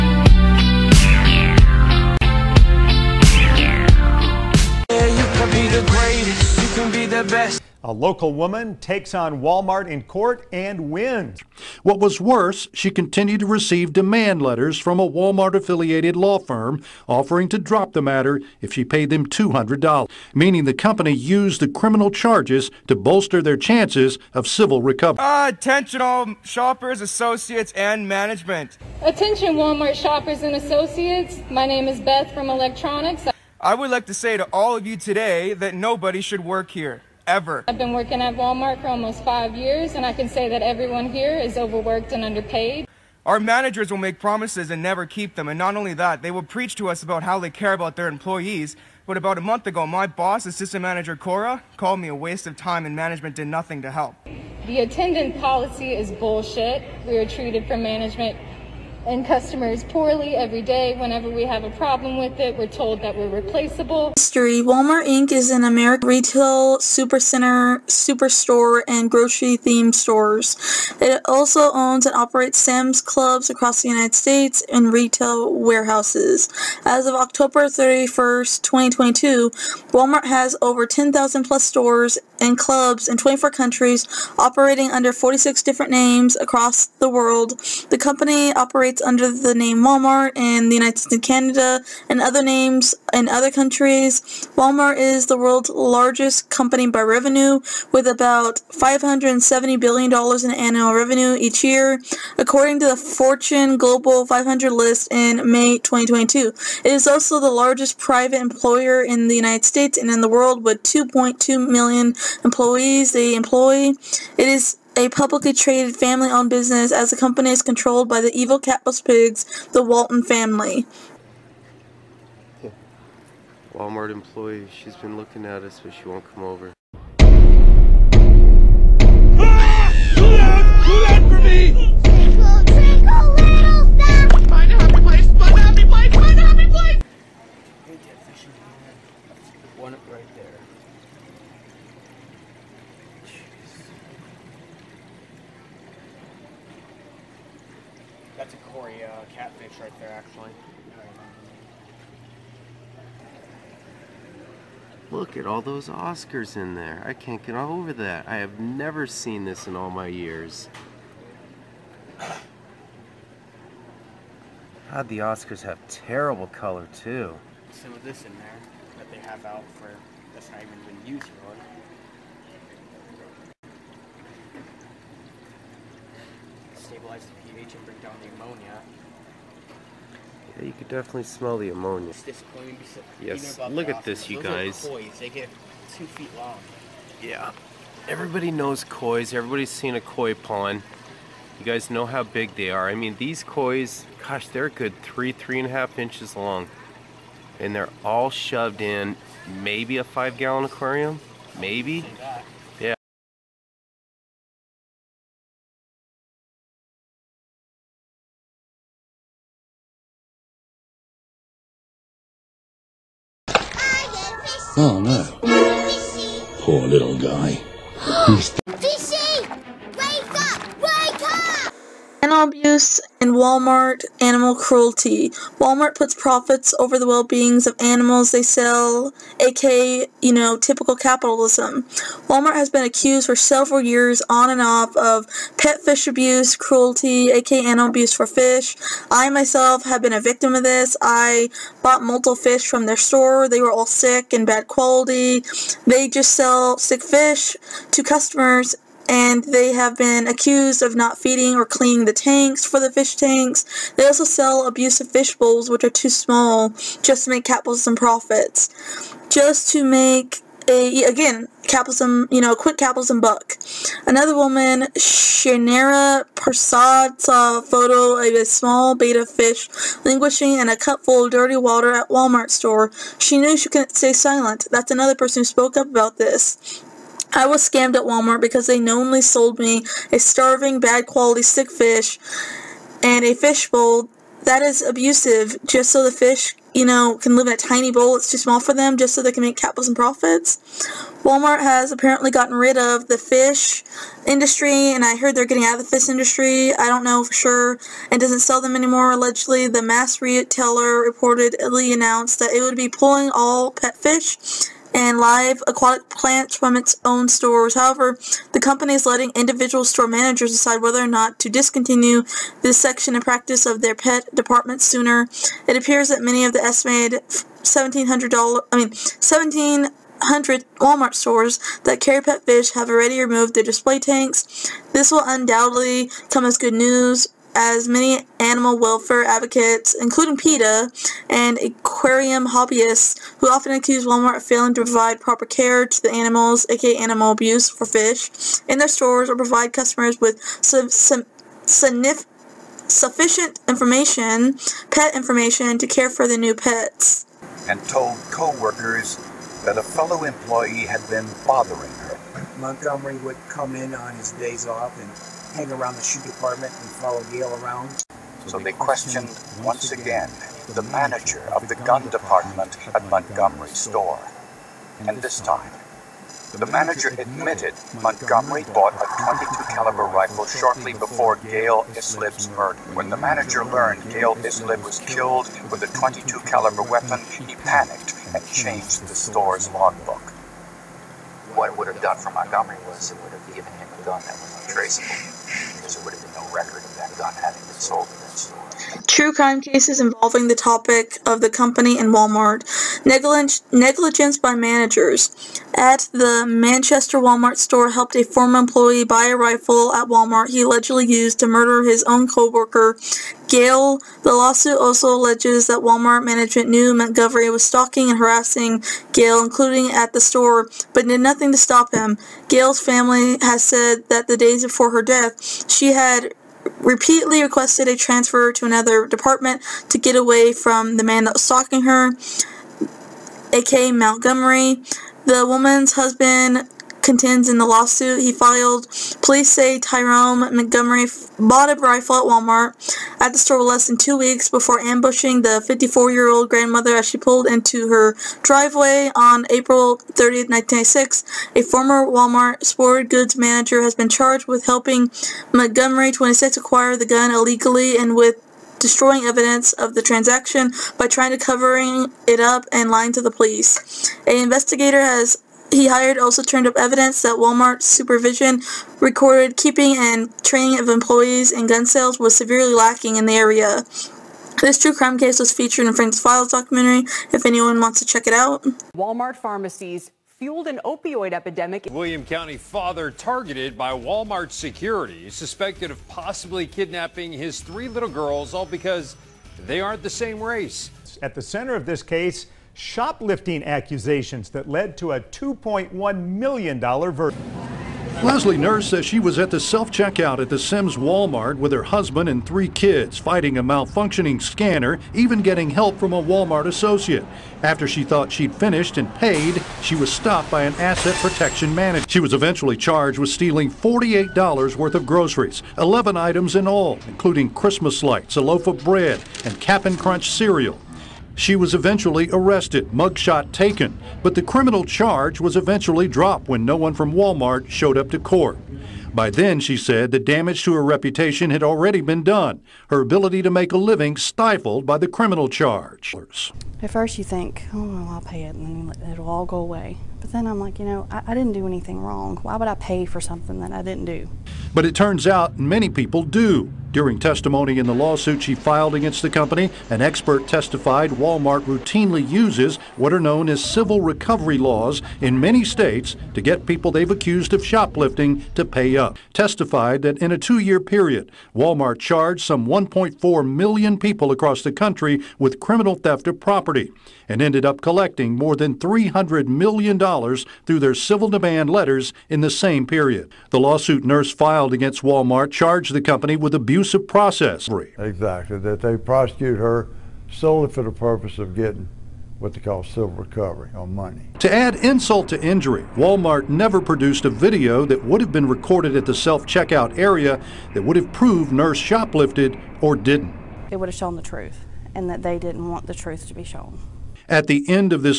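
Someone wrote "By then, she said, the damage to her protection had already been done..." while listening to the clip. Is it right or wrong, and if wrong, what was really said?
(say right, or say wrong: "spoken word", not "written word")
wrong: "reputation", not "protection".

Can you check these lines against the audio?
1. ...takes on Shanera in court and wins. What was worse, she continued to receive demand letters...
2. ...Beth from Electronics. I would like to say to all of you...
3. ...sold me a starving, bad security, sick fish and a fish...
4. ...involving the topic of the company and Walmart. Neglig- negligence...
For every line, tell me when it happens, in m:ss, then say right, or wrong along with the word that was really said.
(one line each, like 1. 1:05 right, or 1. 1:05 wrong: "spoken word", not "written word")
1. 0:08 wrong: "Walmart", not "Shanera"
2. 0:32 right
3. 4:39 wrong: "quality", not "security"
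4. 6:29 right.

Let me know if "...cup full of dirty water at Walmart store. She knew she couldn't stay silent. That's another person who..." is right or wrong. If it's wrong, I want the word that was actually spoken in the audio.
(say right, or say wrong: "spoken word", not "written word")
right.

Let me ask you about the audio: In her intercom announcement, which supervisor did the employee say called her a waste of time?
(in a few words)
Cora.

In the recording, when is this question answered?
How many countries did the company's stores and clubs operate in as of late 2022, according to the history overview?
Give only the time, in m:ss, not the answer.
1:23.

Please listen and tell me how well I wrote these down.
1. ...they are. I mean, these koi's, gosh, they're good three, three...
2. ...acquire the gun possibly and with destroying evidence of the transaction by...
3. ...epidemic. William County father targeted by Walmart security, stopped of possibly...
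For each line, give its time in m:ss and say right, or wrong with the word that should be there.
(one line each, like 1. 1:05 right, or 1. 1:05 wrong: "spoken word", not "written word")
1. 3:12 right
2. 7:26 wrong: "illegally", not "possibly"
3. 7:51 wrong: "suspected", not "stopped".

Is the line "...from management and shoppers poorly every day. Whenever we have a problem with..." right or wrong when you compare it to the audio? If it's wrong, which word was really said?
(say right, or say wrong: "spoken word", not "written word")
wrong: "customers", not "shoppers".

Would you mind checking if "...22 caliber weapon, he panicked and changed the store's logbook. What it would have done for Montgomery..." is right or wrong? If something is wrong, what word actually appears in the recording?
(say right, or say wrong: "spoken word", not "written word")
right.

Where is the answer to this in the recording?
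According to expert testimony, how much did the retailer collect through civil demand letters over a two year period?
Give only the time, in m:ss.
9:18.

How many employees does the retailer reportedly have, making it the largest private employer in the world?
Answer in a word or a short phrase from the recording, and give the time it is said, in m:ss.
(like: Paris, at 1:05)
2.2 million, at 1:50.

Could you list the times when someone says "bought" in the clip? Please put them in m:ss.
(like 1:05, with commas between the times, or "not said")
4:01, 6:08, 7:11.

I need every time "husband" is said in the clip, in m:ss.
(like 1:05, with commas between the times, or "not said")
7:05, 8:11.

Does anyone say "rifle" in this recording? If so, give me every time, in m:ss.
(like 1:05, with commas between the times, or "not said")
6:10, 6:39, 7:11.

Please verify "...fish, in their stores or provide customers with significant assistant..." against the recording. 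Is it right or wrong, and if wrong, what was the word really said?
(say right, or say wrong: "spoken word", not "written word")
wrong: "sufficient", not "assistant".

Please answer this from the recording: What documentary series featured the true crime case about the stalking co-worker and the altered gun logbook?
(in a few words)
Forensic Files.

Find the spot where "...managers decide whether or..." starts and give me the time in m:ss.
5:10.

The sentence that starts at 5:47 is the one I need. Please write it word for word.
And told co-workers that a fellow employee had been bothering her.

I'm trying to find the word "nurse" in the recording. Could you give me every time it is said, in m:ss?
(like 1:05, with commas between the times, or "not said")
8:08, 9:24, 9:41.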